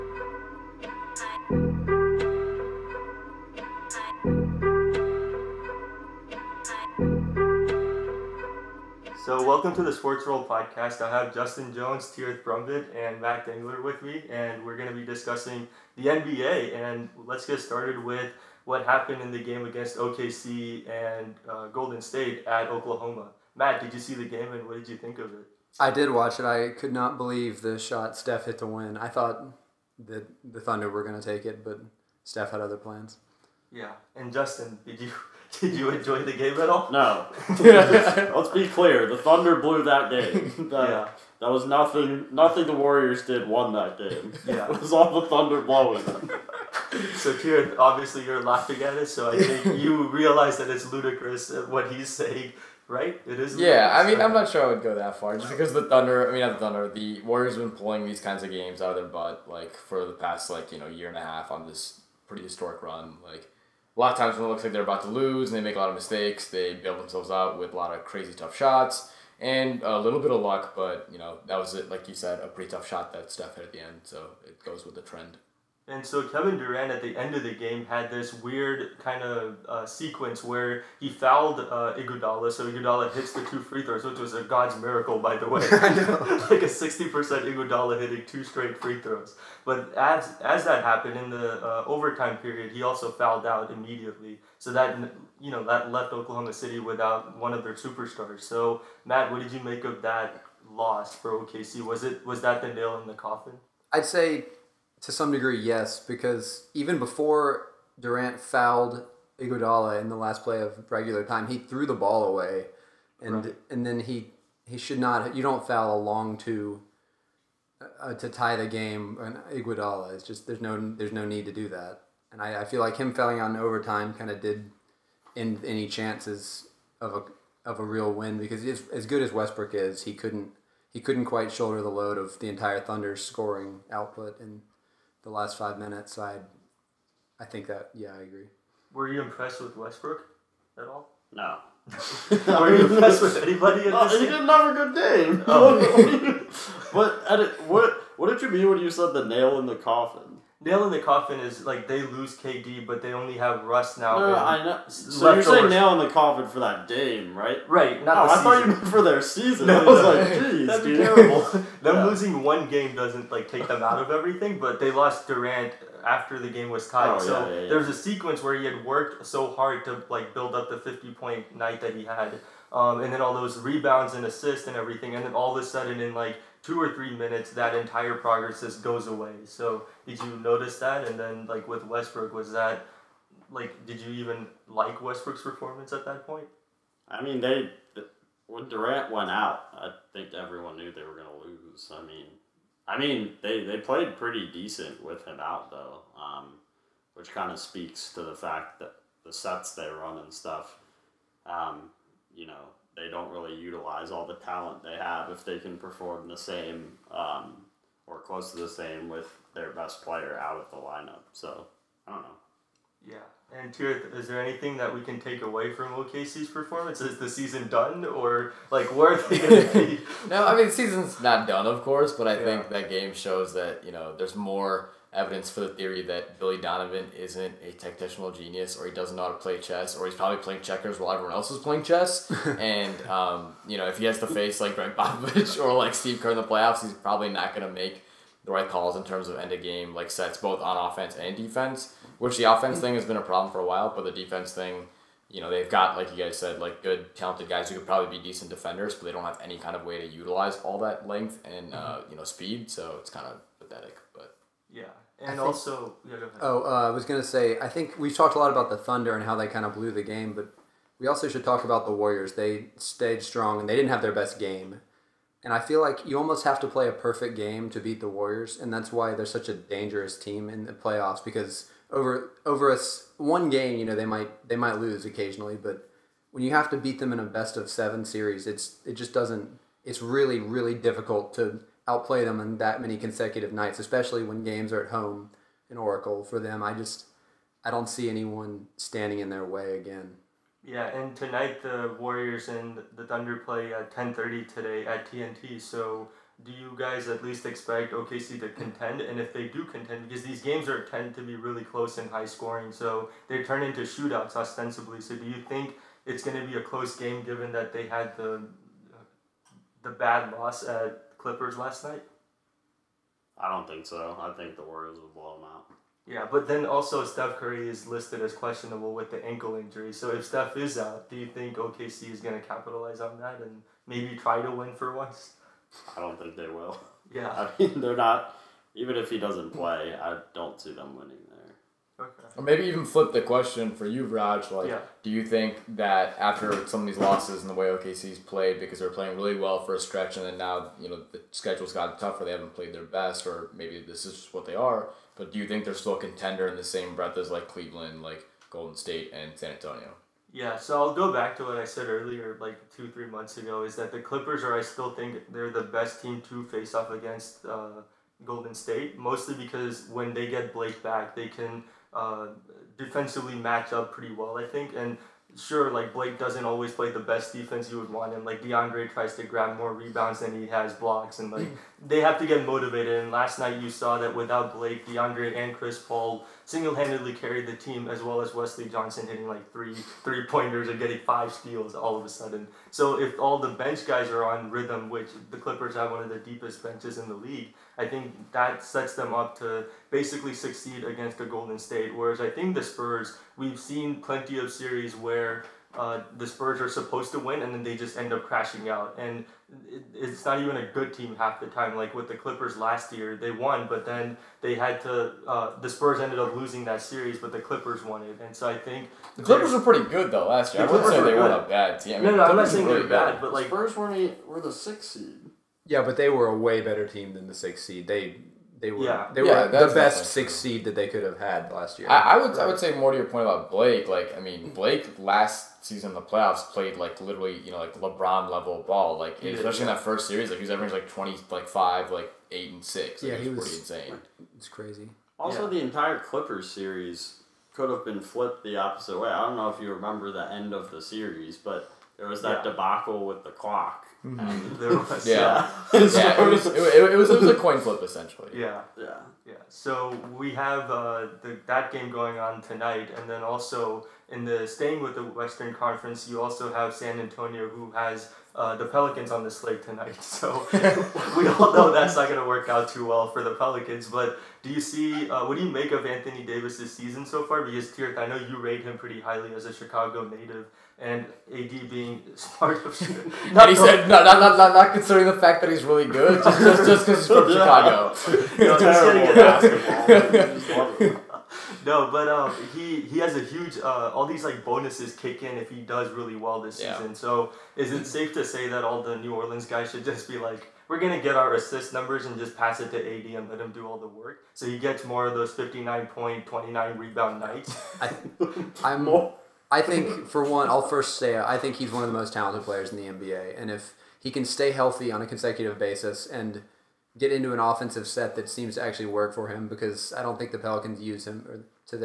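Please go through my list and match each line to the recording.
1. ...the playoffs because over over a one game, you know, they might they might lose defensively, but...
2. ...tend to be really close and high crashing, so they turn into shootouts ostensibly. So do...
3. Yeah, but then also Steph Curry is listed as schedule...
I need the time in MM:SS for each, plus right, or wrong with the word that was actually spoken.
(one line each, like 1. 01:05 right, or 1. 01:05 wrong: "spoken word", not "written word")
1. 04:30 wrong: "occasionally", not "defensively"
2. 05:00 wrong: "scoring", not "crashing"
3. 05:16 wrong: "questionable", not "schedule".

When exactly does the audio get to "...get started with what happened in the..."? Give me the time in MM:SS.
00:17.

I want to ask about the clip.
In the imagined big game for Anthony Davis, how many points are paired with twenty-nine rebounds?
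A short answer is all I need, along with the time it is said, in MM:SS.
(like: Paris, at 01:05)
59, at 08:15.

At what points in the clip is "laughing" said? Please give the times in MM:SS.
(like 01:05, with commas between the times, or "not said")
00:48.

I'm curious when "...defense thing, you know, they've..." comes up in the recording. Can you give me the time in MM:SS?
04:04.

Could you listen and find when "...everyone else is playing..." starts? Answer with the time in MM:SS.
03:51.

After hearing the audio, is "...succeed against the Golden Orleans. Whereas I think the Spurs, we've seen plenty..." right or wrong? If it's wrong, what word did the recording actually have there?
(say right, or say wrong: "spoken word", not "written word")
wrong: "State", not "Orleans".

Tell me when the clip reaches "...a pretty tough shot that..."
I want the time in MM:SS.
01:12.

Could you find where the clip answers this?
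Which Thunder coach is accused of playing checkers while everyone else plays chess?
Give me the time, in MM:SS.
03:46.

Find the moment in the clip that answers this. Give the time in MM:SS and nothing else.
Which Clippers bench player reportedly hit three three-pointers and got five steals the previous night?
06:18.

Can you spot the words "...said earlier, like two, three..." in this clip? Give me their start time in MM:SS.
05:51.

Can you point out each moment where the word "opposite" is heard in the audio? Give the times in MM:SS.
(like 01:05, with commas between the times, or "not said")
07:18.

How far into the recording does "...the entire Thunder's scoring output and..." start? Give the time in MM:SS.
02:12.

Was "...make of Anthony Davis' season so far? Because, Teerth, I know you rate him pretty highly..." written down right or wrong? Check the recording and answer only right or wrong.
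right.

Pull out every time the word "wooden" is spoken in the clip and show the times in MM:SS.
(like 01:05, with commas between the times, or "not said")
not said.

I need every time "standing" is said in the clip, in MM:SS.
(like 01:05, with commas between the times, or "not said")
04:48.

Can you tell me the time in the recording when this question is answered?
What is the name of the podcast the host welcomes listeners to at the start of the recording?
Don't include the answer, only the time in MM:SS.
00:09.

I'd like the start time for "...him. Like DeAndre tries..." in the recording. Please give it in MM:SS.
06:08.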